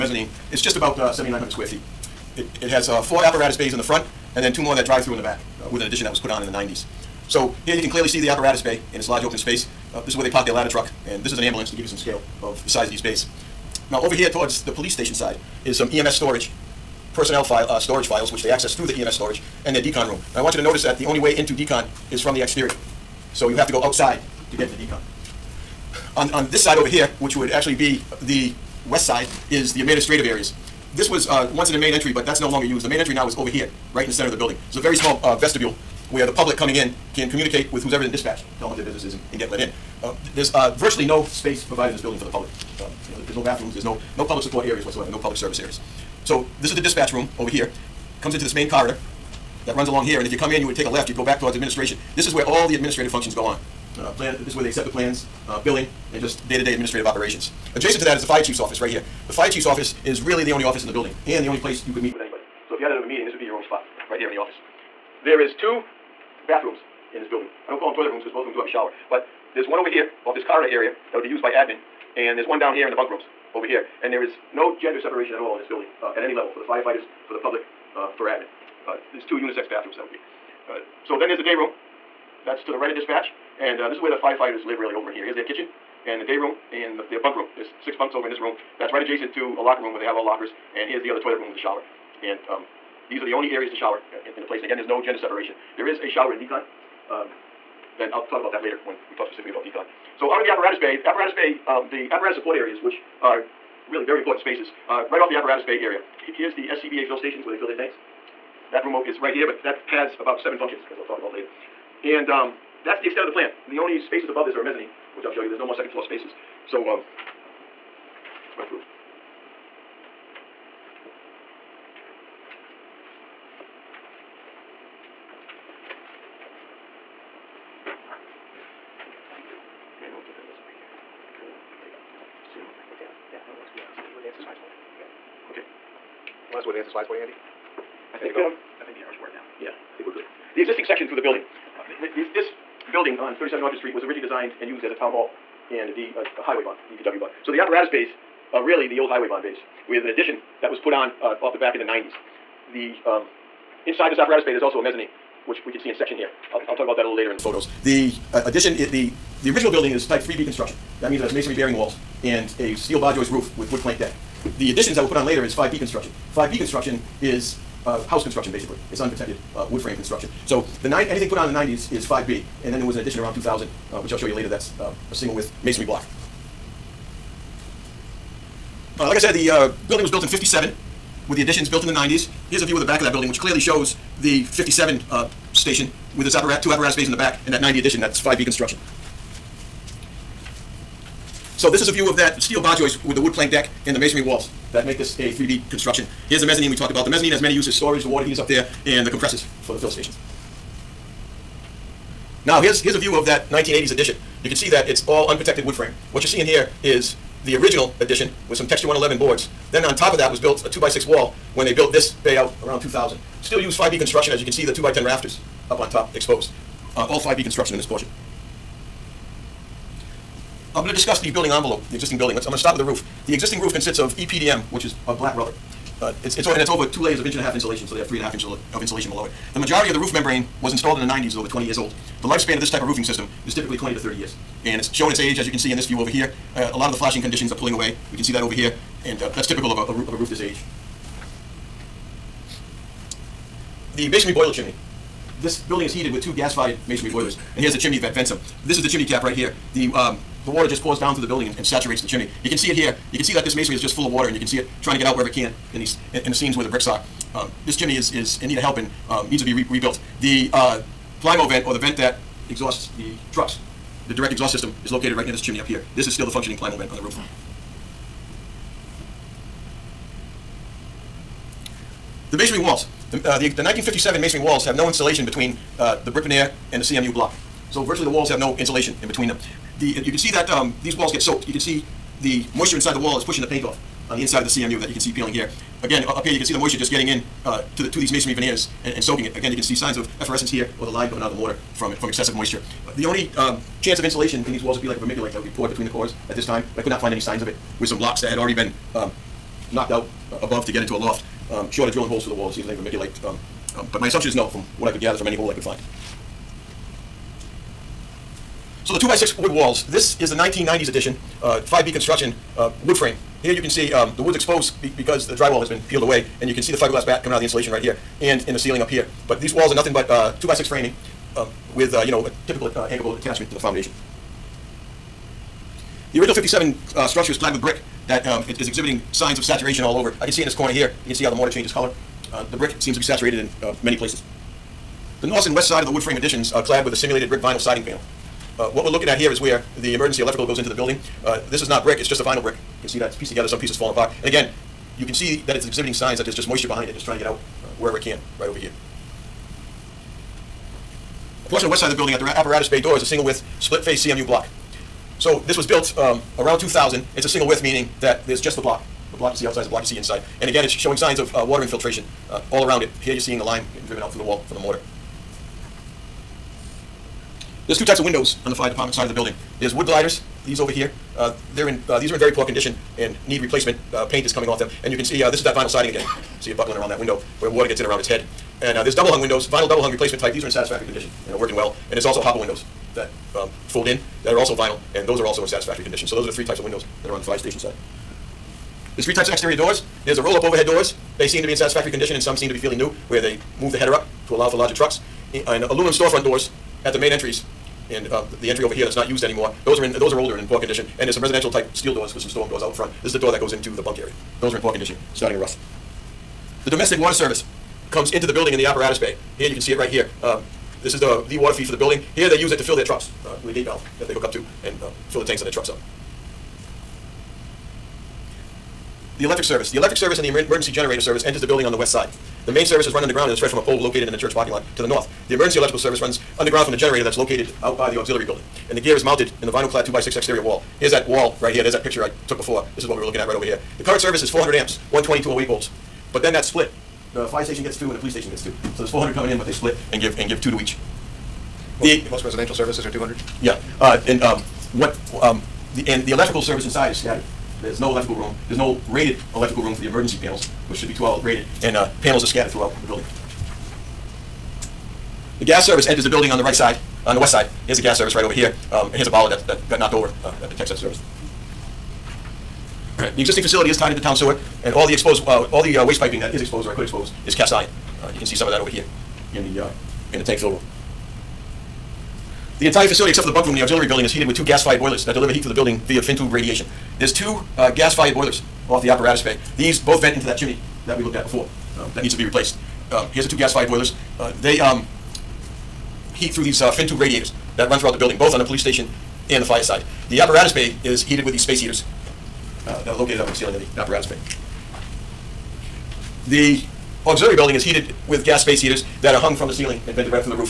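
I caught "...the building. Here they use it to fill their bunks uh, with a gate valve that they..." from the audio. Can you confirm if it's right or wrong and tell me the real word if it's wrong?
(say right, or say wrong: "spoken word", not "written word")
wrong: "trucks", not "bunks".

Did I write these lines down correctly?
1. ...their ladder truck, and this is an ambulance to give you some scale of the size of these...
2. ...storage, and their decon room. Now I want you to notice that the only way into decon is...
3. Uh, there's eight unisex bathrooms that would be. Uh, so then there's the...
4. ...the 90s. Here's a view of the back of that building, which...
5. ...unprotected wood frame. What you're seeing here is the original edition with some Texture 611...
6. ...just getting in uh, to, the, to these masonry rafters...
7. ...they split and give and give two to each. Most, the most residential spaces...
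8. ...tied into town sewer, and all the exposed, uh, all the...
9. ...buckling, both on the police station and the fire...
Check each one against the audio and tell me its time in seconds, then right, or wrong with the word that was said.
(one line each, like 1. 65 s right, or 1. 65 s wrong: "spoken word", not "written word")
1. 10 s right
2. 19 s right
3. 78 s wrong: "two", not "eight"
4. 181 s right
5. 205 s wrong: "111", not "611"
6. 286 s wrong: "veneers", not "rafters"
7. 439 s wrong: "services", not "spaces"
8. 463 s right
9. 487 s wrong: "building", not "buckling".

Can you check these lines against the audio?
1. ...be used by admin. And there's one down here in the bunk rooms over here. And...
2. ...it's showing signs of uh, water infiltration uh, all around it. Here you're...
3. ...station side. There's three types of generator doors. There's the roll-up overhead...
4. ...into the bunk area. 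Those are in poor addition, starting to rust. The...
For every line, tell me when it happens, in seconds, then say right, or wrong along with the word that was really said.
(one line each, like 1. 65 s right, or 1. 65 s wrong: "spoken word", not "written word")
1. 71 s right
2. 360 s right
3. 387 s wrong: "exterior", not "generator"
4. 403 s wrong: "condition", not "addition".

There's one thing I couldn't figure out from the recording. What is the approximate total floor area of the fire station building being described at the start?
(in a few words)
7,900 square feet.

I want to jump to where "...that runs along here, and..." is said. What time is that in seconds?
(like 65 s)
49 s.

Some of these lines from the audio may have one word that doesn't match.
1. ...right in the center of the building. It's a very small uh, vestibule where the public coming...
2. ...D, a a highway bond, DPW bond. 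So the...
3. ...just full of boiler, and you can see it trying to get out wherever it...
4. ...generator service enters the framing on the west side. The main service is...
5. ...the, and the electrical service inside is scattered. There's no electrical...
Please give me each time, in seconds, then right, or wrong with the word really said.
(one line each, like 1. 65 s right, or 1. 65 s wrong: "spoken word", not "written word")
1. 33 s right
2. 145 s right
3. 253 s wrong: "water", not "boiler"
4. 420 s wrong: "building", not "framing"
5. 445 s right.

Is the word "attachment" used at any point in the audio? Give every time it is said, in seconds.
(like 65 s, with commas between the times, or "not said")
323 s.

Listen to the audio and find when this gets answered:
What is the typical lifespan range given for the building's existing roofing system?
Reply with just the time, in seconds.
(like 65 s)
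233 s.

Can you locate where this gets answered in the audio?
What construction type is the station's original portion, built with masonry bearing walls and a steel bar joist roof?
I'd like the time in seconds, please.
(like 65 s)
160 s.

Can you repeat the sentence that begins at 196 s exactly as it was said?
Here's the mezzanine we talked about.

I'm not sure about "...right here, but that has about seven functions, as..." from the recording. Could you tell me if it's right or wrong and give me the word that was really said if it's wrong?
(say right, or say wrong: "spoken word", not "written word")
right.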